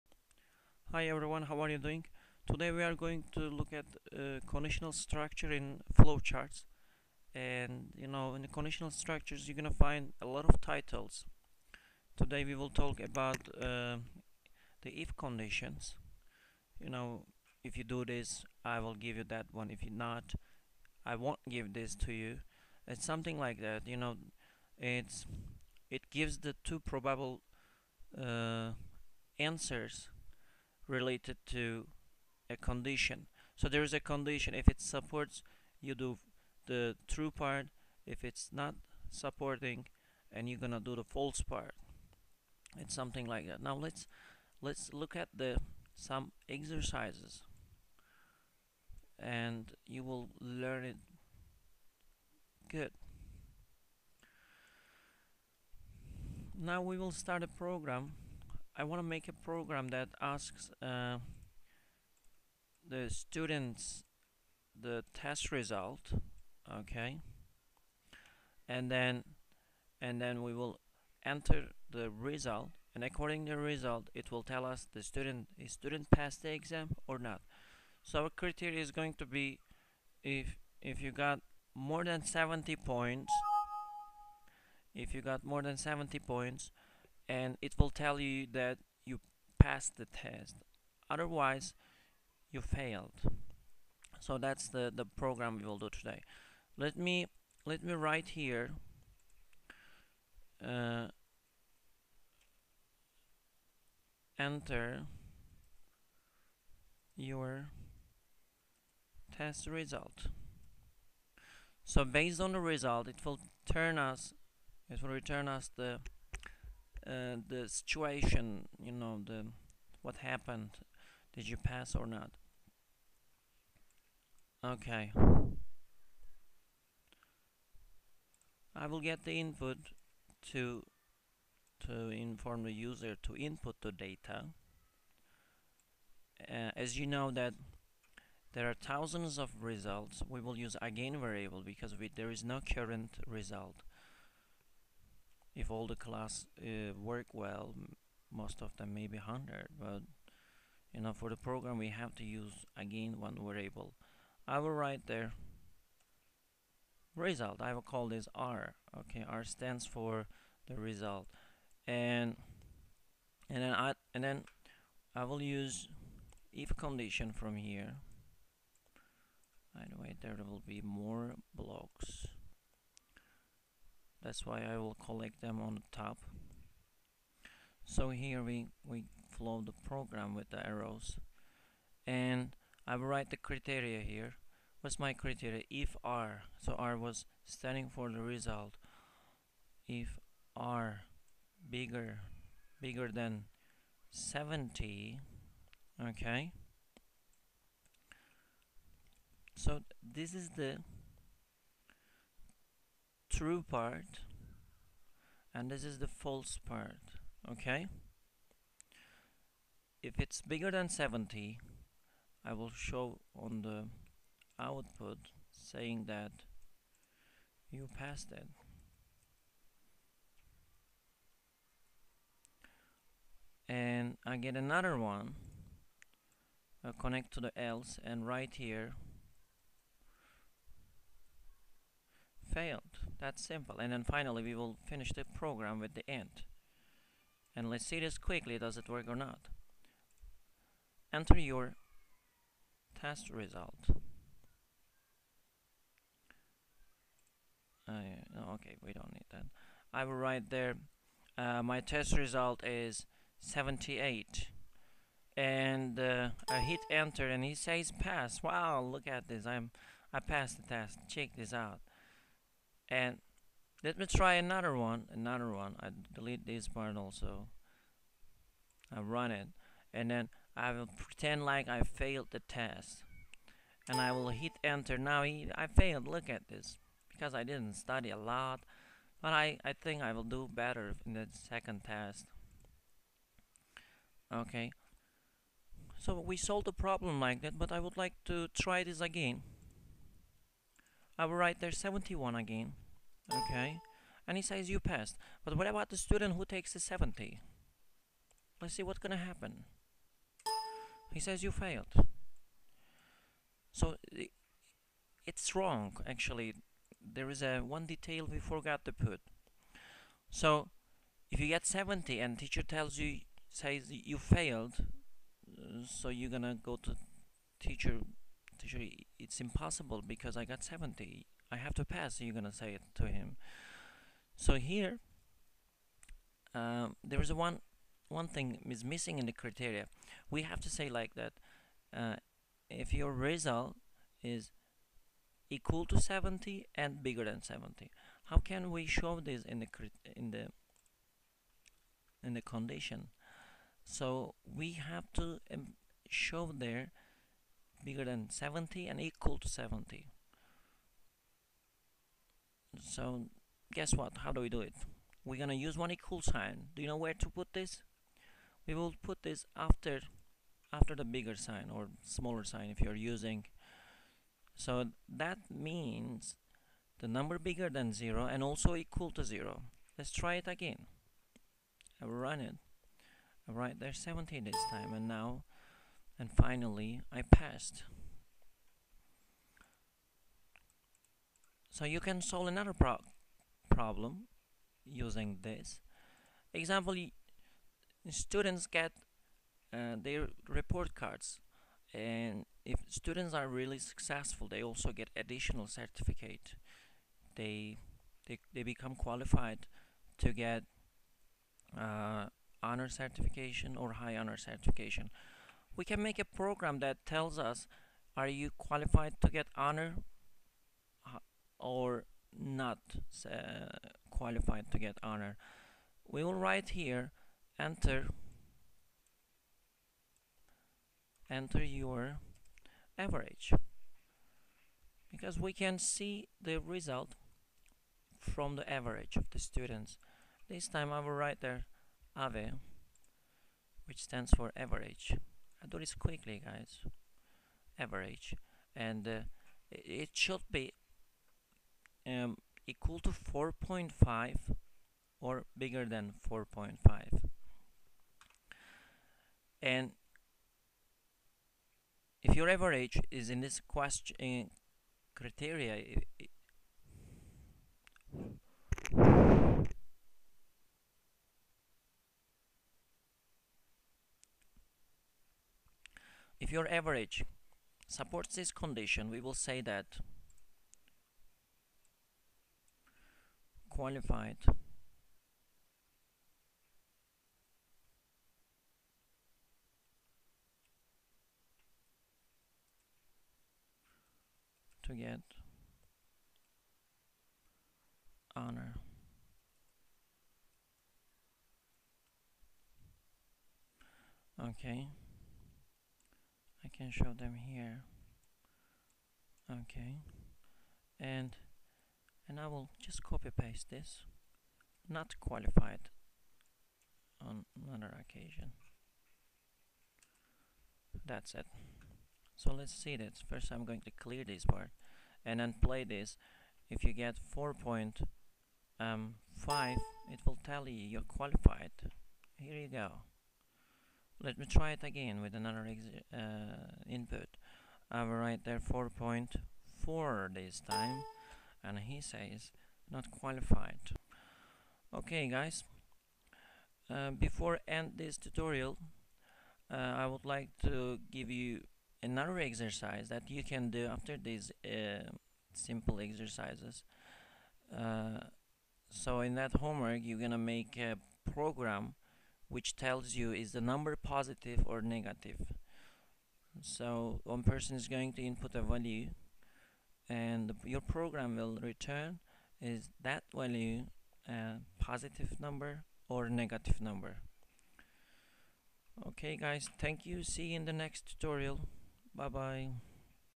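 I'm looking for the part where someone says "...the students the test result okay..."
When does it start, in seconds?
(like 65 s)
62 s.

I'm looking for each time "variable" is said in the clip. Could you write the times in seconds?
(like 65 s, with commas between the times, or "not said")
141 s, 153 s.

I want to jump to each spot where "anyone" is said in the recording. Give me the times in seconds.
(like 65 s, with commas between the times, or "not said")
not said.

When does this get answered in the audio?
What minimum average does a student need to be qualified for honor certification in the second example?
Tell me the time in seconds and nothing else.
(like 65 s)
442 s.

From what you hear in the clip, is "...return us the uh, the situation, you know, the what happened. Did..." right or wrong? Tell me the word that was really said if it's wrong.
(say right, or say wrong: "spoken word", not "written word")
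right.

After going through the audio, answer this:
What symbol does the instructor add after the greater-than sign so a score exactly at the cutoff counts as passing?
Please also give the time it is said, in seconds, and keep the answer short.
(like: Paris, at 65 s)
equal sign, at 355 s.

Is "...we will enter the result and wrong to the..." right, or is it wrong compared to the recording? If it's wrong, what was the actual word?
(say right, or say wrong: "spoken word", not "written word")
wrong: "according", not "wrong".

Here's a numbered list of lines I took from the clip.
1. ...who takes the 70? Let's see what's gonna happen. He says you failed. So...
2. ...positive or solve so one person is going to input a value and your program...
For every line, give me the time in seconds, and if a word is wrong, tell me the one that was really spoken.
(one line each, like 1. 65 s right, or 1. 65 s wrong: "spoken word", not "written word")
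1. 296 s right
2. 553 s wrong: "negative", not "solve".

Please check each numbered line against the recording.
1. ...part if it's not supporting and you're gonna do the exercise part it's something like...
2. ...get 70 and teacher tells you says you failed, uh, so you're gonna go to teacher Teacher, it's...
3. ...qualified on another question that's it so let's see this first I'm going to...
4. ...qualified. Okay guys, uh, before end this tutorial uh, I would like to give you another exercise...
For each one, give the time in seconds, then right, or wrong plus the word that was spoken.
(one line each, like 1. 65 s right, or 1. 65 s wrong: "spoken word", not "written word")
1. 37 s wrong: "false", not "exercise"
2. 311 s right
3. 505 s wrong: "occasion", not "question"
4. 533 s right.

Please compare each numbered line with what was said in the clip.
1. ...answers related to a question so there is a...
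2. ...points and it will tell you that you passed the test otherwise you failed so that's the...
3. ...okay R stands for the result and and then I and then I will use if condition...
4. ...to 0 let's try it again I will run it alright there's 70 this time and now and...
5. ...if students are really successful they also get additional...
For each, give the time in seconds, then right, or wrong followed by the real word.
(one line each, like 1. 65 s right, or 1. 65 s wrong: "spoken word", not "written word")
1. 29 s wrong: "condition", not "question"
2. 86 s right
3. 158 s right
4. 369 s right
5. 392 s right.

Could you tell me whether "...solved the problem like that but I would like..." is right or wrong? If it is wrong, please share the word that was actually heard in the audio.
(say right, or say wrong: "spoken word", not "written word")
right.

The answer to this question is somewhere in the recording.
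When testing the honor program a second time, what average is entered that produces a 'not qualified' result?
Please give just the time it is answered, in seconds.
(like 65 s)
528 s.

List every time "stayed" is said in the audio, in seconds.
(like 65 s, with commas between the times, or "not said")
not said.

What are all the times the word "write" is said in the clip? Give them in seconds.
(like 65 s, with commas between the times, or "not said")
97 s, 154 s, 183 s, 250 s, 291 s, 416 s, 431 s, 528 s.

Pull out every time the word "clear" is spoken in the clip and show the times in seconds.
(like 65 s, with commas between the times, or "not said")
513 s.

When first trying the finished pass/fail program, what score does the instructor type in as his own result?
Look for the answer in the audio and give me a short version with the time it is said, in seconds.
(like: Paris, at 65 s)
78, at 251 s.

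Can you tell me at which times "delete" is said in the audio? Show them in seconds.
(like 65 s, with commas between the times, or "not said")
266 s.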